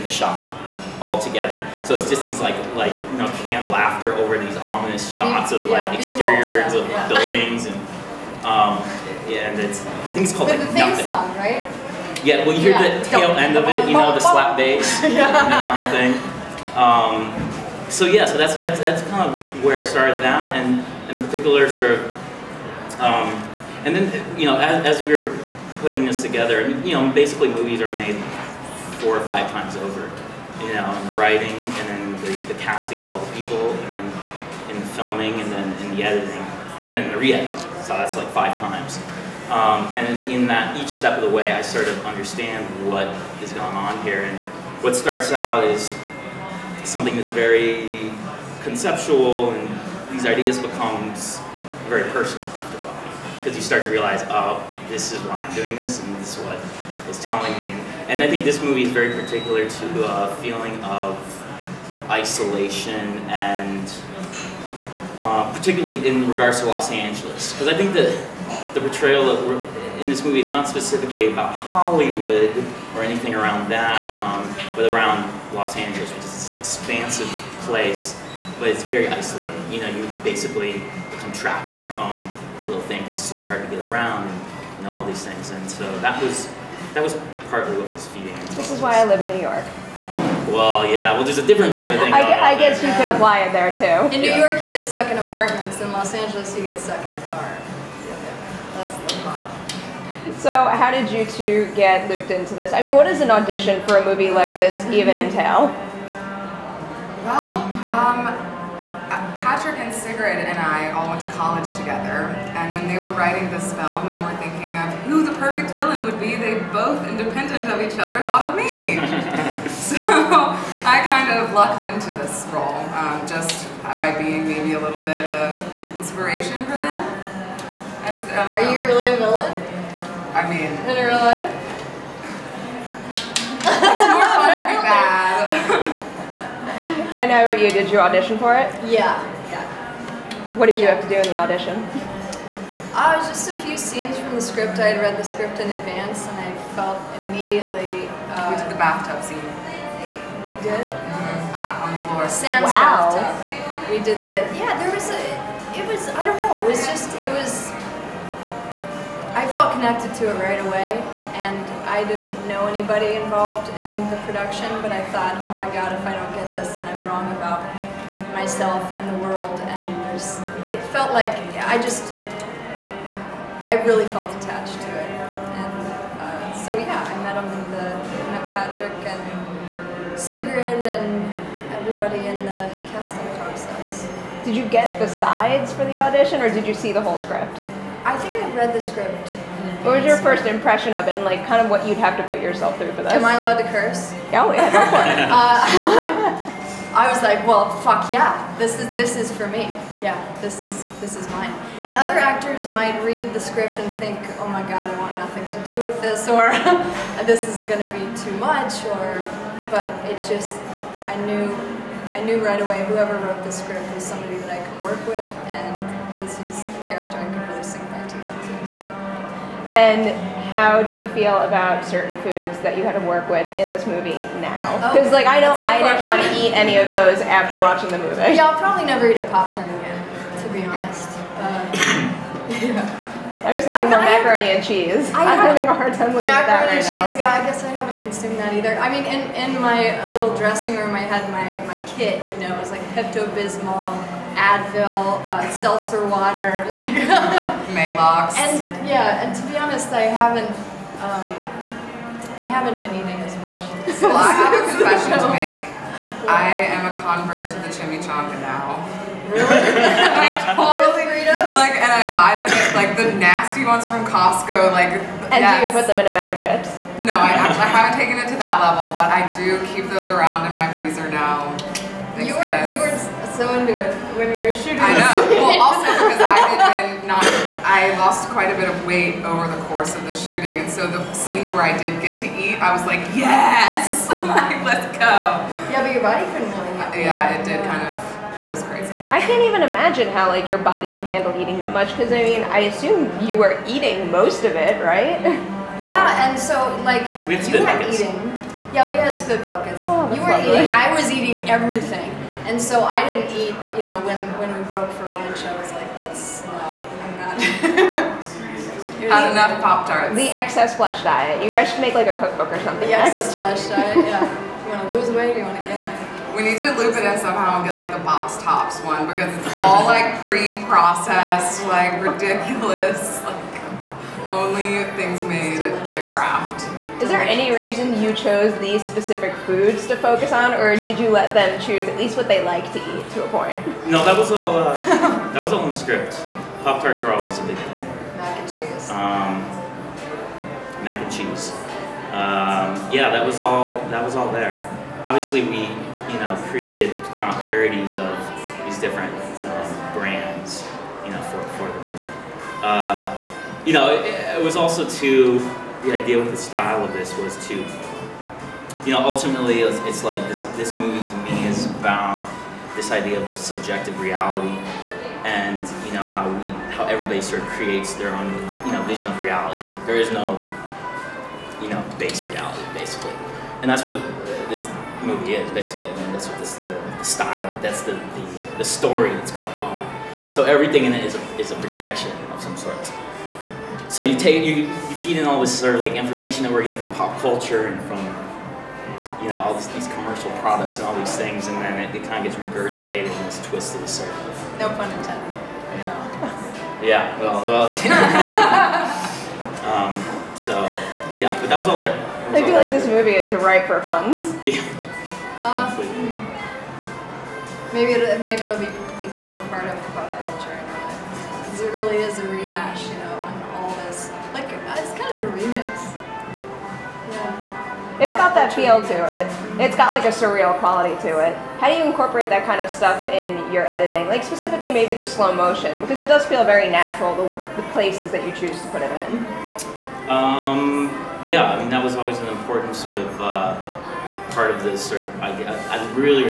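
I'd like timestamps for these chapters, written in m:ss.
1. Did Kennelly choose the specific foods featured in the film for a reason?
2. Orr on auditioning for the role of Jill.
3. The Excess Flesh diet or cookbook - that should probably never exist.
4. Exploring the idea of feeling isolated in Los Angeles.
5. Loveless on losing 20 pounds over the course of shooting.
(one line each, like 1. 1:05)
1. 5:25
2. 2:15
3. 5:08
4. 0:56
5. 4:36.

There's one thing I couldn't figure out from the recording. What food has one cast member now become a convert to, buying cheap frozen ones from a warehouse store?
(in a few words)
Chimichanga.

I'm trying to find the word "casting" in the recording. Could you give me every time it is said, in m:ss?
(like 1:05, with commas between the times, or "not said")
0:32, 3:02.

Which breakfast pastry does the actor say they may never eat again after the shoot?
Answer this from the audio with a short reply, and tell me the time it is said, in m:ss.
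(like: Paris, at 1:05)
Pop Tart, at 3:49.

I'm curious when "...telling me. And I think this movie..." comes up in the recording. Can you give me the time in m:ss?
0:57.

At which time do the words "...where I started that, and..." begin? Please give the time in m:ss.
0:19.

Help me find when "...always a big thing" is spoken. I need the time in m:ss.
5:37.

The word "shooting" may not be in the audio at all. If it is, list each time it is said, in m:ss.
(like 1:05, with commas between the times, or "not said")
4:34, 4:40.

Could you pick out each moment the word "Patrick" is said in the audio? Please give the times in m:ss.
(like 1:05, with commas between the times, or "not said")
1:49, 2:58.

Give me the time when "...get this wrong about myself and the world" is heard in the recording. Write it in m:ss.
2:46.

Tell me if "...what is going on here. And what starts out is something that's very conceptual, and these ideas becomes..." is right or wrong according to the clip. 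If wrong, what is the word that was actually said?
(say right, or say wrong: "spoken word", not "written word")
right.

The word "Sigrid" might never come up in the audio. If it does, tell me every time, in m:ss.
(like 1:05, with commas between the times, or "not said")
1:49, 3:00.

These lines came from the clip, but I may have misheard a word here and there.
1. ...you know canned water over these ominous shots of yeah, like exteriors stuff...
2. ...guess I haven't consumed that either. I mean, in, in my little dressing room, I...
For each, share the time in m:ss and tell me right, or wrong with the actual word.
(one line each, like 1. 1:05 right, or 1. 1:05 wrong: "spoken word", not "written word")
1. 0:03 wrong: "laughter", not "water"
2. 3:57 right.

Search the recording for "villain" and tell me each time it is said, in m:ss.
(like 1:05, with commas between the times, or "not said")
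1:55, 2:09.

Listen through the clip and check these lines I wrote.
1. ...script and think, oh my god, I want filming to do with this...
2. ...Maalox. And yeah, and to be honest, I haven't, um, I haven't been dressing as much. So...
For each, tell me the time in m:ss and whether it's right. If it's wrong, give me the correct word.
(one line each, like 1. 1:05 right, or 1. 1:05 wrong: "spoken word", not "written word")
1. 3:23 wrong: "nothing", not "filming"
2. 4:07 wrong: "eating", not "dressing".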